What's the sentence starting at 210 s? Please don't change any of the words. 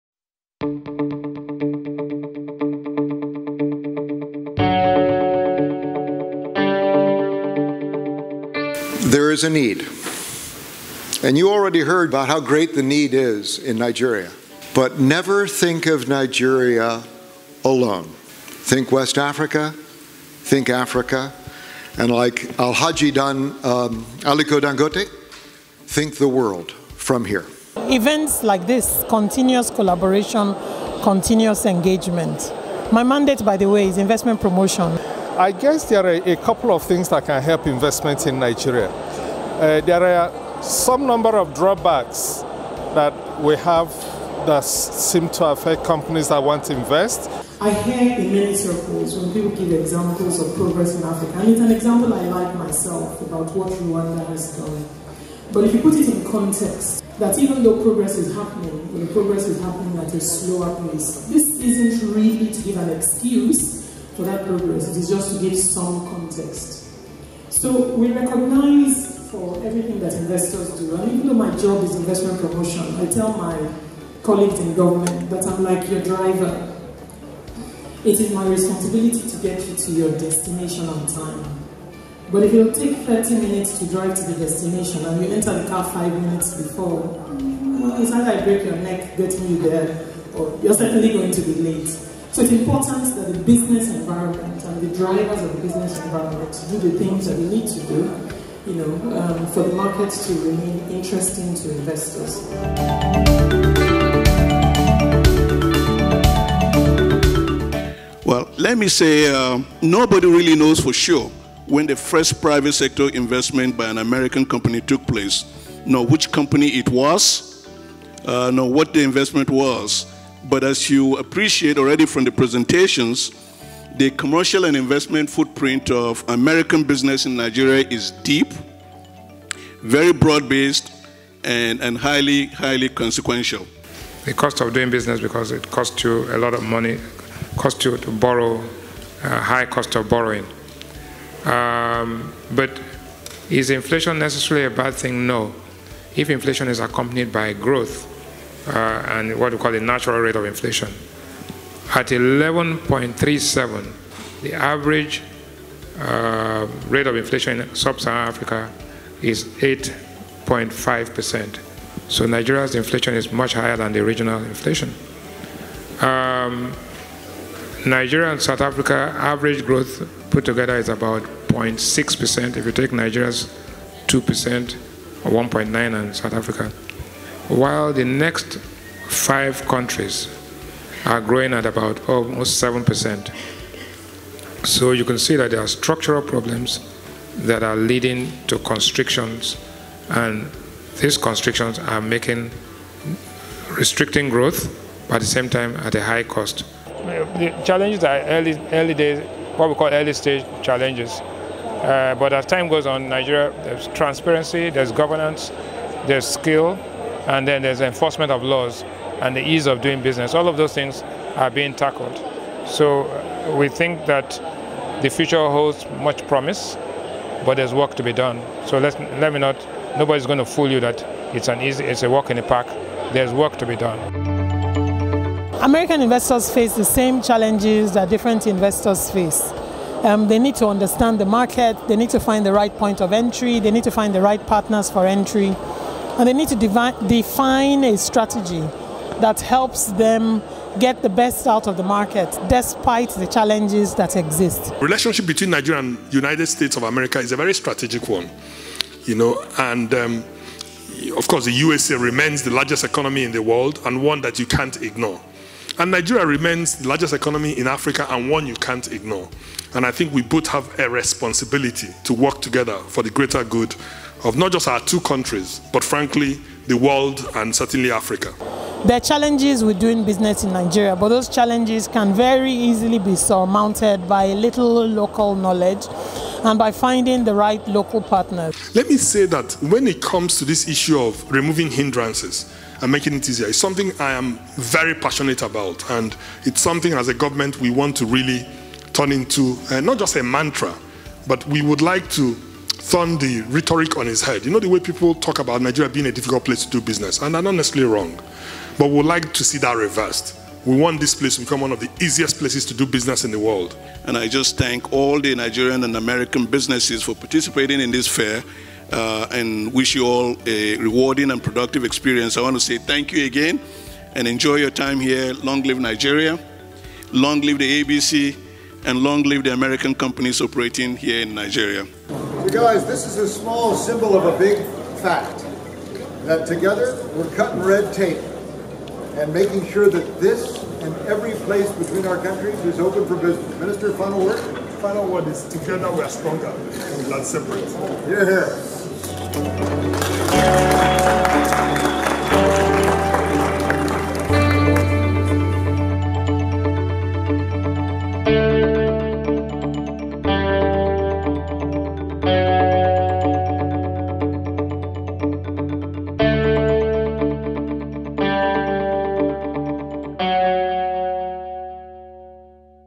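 All of those things are being tackled.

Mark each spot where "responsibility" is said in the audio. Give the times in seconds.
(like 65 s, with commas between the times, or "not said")
78 s, 260 s.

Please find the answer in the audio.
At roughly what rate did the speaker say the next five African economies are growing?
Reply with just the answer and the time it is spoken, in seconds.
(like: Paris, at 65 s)
almost 7%, at 182 s.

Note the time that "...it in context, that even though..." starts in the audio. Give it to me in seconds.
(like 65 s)
55 s.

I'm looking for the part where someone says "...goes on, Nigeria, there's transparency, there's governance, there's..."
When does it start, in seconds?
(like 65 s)
202 s.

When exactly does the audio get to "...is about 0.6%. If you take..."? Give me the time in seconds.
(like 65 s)
170 s.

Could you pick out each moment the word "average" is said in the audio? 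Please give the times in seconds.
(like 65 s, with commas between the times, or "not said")
154 s, 169 s.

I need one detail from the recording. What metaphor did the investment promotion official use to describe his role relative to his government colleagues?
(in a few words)
driver.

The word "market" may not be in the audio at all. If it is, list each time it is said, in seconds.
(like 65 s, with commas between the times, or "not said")
99 s, 231 s, 241 s.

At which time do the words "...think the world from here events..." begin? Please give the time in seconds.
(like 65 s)
25 s.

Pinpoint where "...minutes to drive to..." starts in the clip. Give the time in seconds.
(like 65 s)
83 s.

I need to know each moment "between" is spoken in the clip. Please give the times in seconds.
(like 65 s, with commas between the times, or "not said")
245 s, 331 s.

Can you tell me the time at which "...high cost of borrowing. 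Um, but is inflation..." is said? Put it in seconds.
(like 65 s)
139 s.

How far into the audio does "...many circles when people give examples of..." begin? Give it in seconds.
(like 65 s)
48 s.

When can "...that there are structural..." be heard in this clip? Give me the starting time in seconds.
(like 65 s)
185 s.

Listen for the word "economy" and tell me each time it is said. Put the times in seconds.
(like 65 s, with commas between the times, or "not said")
252 s, 257 s.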